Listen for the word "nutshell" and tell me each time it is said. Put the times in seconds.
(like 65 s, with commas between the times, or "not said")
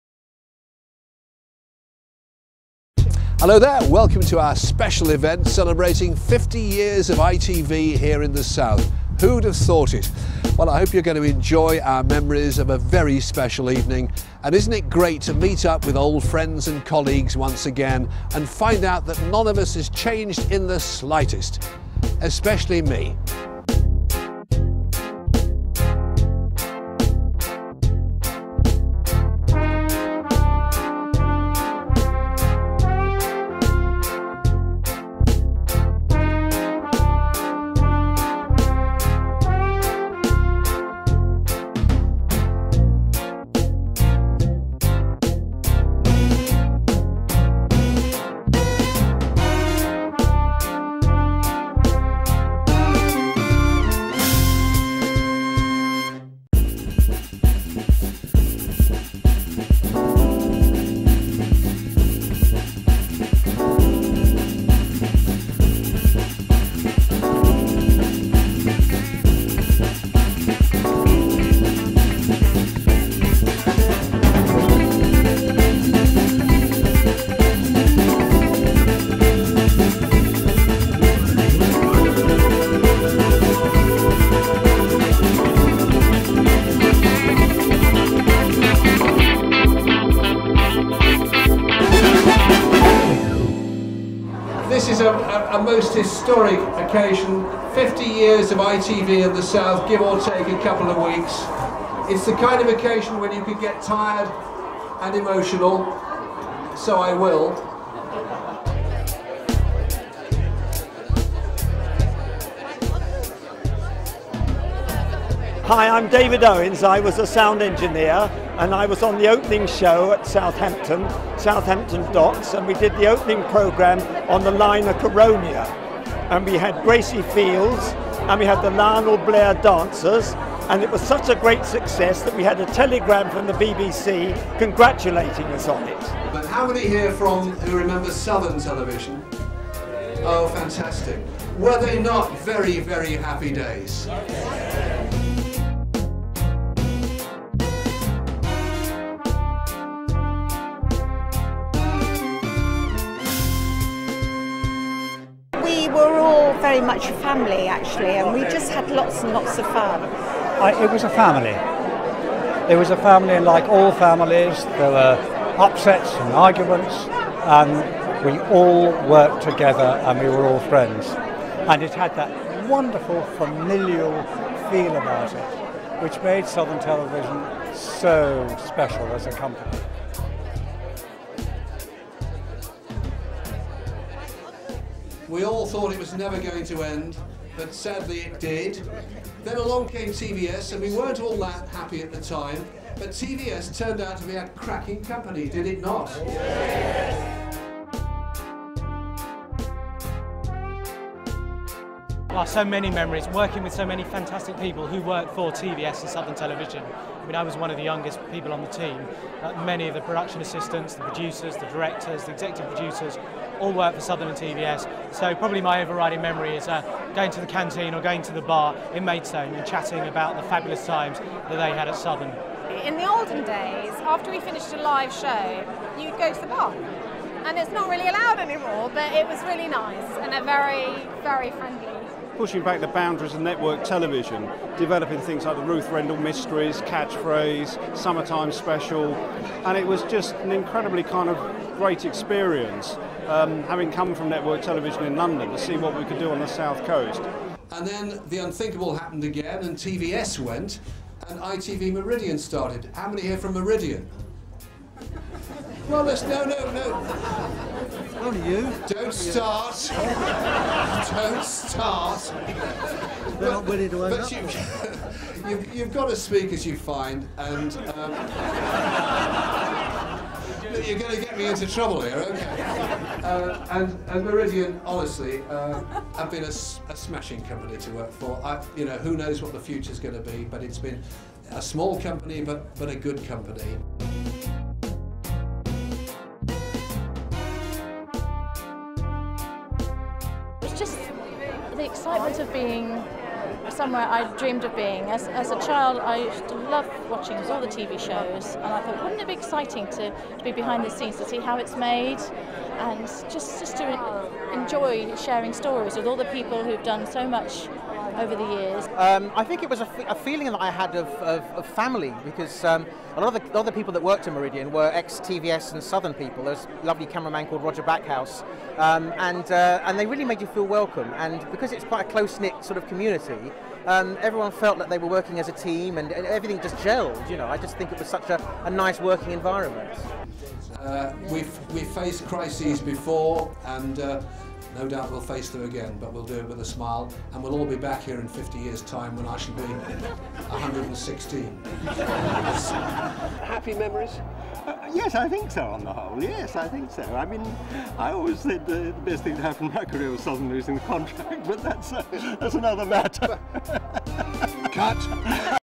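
not said.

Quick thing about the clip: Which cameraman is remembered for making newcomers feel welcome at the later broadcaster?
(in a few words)
Roger Backhouse.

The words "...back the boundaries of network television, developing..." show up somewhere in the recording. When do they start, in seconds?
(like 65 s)
232 s.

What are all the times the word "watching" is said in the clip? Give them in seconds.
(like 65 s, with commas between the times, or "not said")
297 s.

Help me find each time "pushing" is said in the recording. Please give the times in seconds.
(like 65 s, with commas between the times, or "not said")
232 s.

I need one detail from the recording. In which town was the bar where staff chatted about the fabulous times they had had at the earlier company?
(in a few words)
Maidstone.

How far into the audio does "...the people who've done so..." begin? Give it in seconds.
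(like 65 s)
306 s.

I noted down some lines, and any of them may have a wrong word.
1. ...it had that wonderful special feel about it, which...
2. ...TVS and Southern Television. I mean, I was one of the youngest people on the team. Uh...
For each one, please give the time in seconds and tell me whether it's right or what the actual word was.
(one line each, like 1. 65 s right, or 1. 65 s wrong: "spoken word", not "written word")
1. 171 s wrong: "familial", not "special"
2. 205 s right.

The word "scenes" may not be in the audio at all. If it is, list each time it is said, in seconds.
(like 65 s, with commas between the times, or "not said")
300 s.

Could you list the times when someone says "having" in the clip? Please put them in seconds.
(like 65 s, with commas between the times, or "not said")
243 s.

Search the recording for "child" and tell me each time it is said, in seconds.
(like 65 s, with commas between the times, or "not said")
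295 s.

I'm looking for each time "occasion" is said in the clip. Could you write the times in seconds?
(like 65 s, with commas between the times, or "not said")
96 s, 102 s.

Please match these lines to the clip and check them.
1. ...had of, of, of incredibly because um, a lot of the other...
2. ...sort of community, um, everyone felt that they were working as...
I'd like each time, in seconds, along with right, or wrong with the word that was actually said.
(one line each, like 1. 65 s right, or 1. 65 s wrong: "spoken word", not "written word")
1. 310 s wrong: "family", not "incredibly"
2. 322 s right.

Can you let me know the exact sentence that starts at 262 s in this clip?
They're but, not willing to own up.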